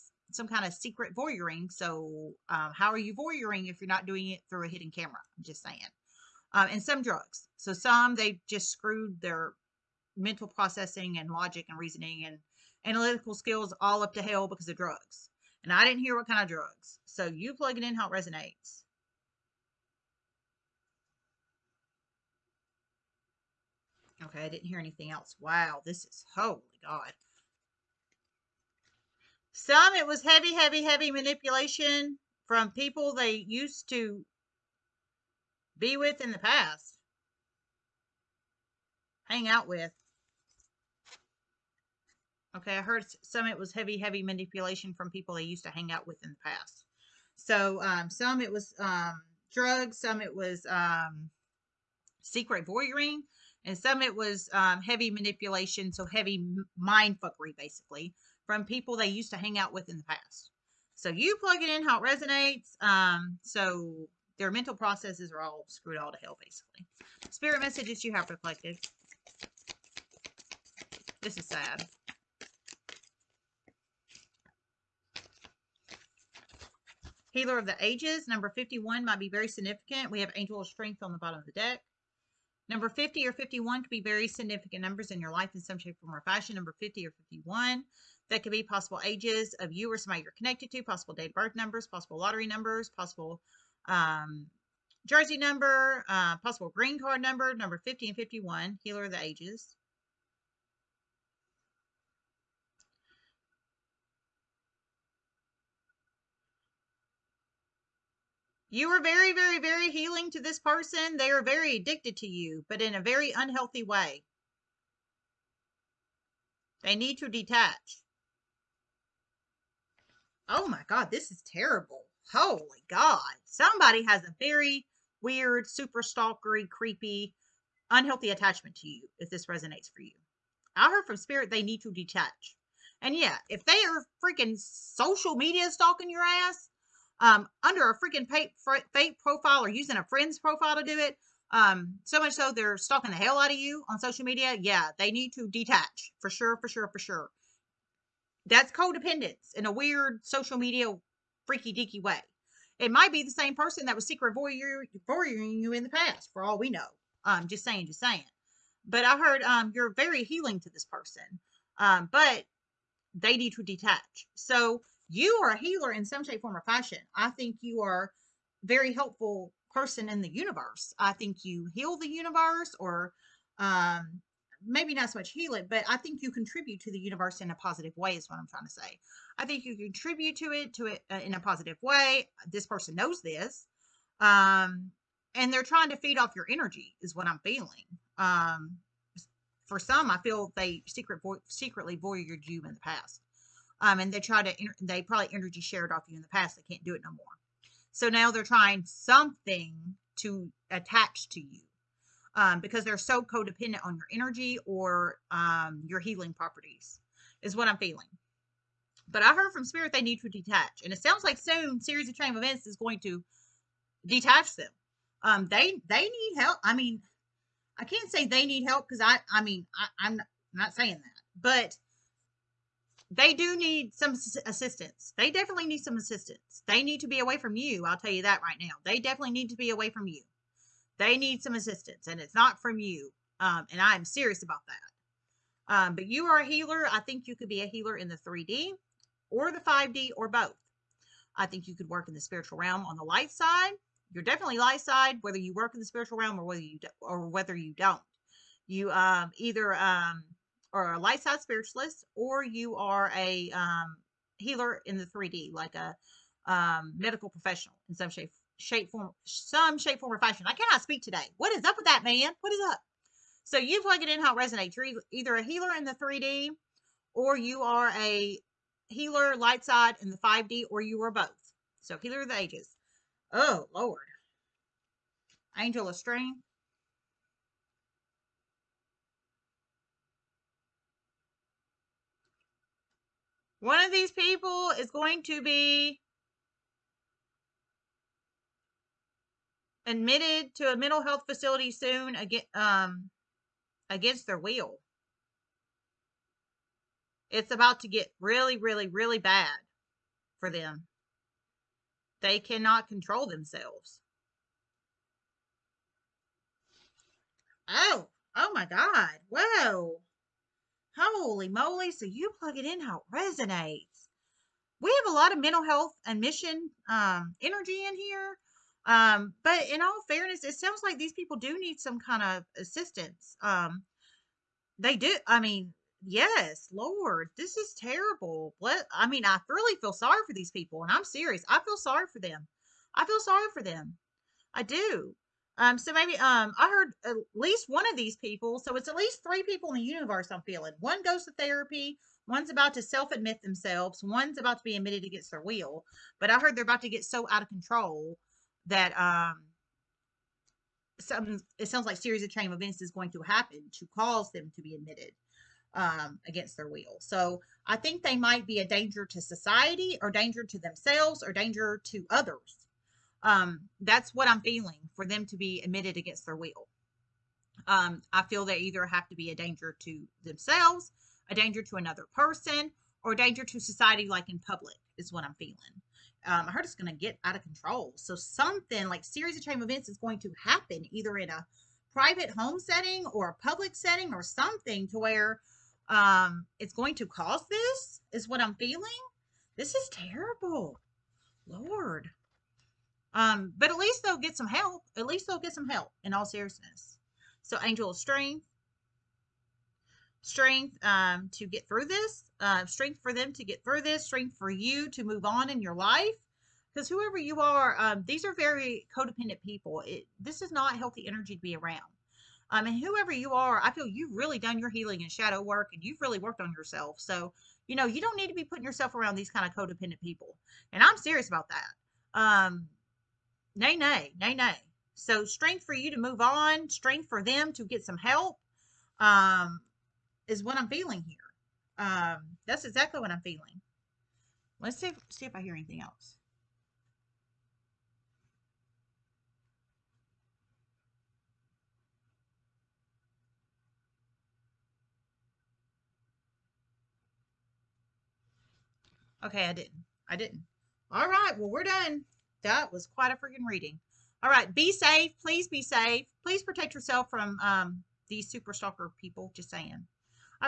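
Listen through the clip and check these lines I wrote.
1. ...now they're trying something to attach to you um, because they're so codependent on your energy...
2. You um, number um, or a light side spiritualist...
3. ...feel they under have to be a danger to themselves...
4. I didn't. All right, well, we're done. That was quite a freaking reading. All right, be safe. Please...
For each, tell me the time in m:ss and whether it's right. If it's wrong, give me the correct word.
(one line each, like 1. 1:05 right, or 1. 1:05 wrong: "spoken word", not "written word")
1. 3:18 right
2. 4:08 wrong: "either", not "number"
3. 6:08 wrong: "either", not "under"
4. 7:30 right.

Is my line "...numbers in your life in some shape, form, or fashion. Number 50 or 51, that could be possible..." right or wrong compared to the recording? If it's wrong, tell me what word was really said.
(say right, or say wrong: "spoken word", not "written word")
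right.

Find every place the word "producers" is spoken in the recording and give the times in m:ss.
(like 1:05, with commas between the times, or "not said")
not said.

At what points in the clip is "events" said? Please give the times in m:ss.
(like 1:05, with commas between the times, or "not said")
3:32, 5:52, 6:19.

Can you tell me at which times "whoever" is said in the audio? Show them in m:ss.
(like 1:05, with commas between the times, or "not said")
6:46, 6:52.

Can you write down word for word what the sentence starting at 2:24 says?
Yeah, they need to detach for sure, for sure, for sure.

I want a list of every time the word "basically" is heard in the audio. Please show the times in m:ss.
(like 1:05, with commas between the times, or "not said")
0:57, 1:06.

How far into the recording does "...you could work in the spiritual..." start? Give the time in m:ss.
4:01.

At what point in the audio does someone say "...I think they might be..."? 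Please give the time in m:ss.
5:57.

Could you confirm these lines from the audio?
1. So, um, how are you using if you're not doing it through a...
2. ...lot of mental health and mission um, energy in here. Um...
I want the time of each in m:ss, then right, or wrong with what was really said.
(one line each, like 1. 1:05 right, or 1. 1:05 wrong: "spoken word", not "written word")
1. 0:01 wrong: "voyeuring", not "using"
2. 5:15 right.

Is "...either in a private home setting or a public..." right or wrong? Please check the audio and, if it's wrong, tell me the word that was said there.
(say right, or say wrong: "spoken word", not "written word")
right.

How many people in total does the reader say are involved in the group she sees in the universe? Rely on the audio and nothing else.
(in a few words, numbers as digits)
3.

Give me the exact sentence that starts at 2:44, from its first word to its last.
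So you are a healer in some shape, form, or fashion.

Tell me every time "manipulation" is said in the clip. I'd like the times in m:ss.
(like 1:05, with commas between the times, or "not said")
0:31, 0:44, 0:55.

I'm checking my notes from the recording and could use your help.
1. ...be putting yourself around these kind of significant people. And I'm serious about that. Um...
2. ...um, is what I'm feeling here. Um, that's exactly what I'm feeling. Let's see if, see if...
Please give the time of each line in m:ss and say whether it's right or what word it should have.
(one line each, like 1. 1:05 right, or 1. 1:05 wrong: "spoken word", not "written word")
1. 6:58 wrong: "codependent", not "significant"
2. 7:08 right.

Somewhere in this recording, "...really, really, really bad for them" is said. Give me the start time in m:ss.
4:58.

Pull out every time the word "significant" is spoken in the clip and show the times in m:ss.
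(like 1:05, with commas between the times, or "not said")
1:19, 1:24.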